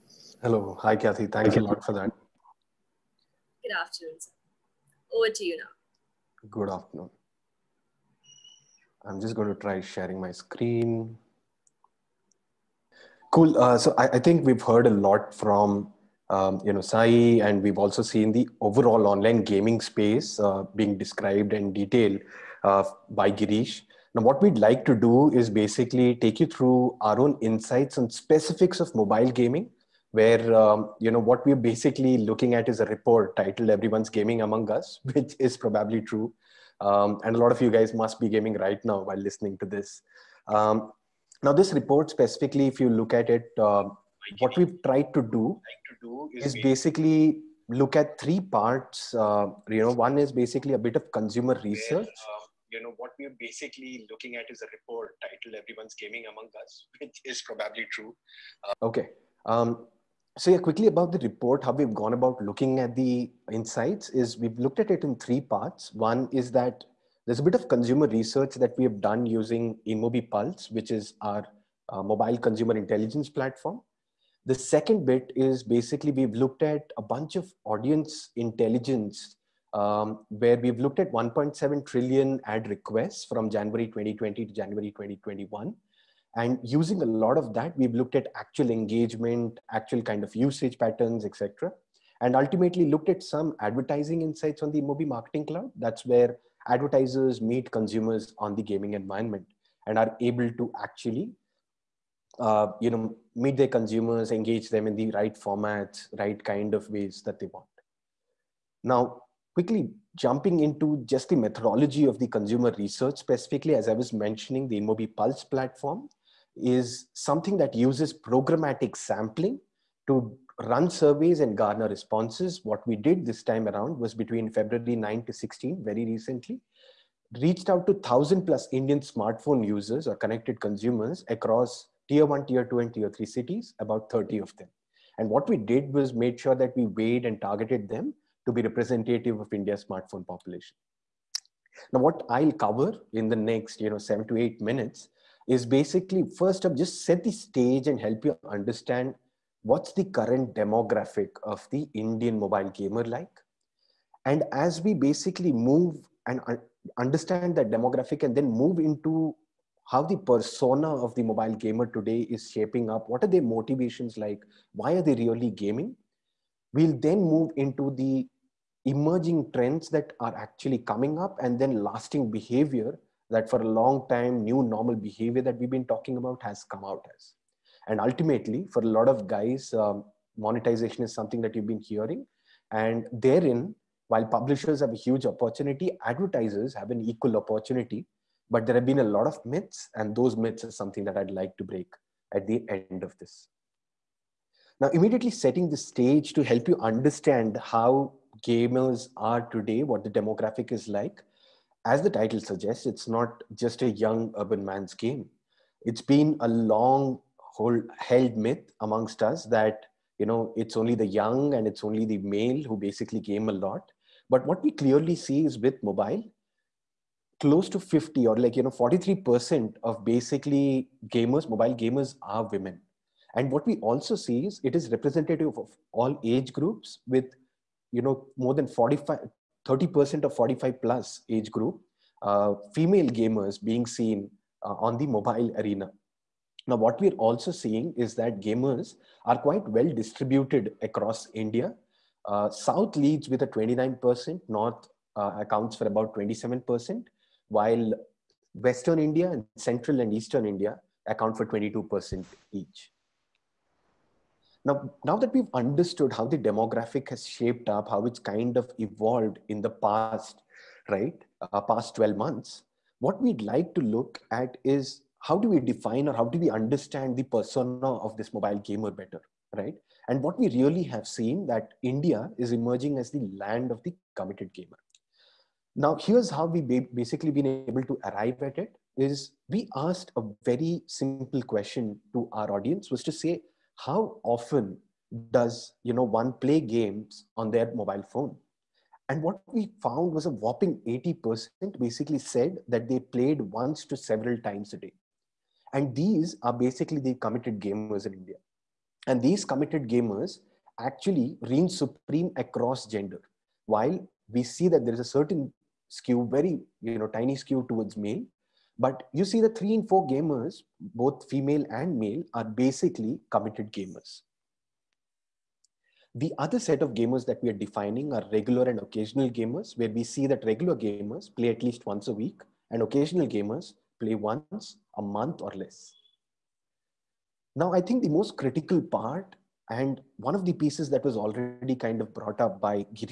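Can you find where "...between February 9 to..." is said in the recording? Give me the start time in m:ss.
2:04.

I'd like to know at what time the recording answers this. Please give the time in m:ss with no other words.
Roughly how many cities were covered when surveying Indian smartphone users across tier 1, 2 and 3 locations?
2:13.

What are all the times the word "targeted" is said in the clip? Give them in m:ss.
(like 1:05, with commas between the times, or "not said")
2:17.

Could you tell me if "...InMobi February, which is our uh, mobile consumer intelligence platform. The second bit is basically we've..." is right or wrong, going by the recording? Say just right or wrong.
wrong.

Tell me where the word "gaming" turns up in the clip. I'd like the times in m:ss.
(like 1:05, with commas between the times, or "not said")
0:19, 0:29, 0:34, 0:38, 0:55, 1:38, 2:45.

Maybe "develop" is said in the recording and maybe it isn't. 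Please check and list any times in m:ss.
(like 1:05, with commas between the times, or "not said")
not said.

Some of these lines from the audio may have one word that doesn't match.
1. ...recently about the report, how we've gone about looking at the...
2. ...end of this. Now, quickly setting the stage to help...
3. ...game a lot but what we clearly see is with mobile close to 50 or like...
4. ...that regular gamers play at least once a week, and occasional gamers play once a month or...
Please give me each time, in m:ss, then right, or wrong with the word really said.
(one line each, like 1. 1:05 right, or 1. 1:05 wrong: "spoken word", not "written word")
1. 1:00 wrong: "quickly", not "recently"
2. 3:12 wrong: "immediately", not "quickly"
3. 3:33 right
4. 5:20 right.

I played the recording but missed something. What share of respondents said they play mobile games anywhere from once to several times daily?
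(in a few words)
80%.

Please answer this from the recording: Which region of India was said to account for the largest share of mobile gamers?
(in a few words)
South.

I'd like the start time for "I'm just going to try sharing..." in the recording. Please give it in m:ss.
0:09.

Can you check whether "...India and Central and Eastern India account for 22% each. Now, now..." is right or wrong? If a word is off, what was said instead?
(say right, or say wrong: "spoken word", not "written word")
right.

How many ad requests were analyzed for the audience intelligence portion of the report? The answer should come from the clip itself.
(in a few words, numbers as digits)
1.7 trillion.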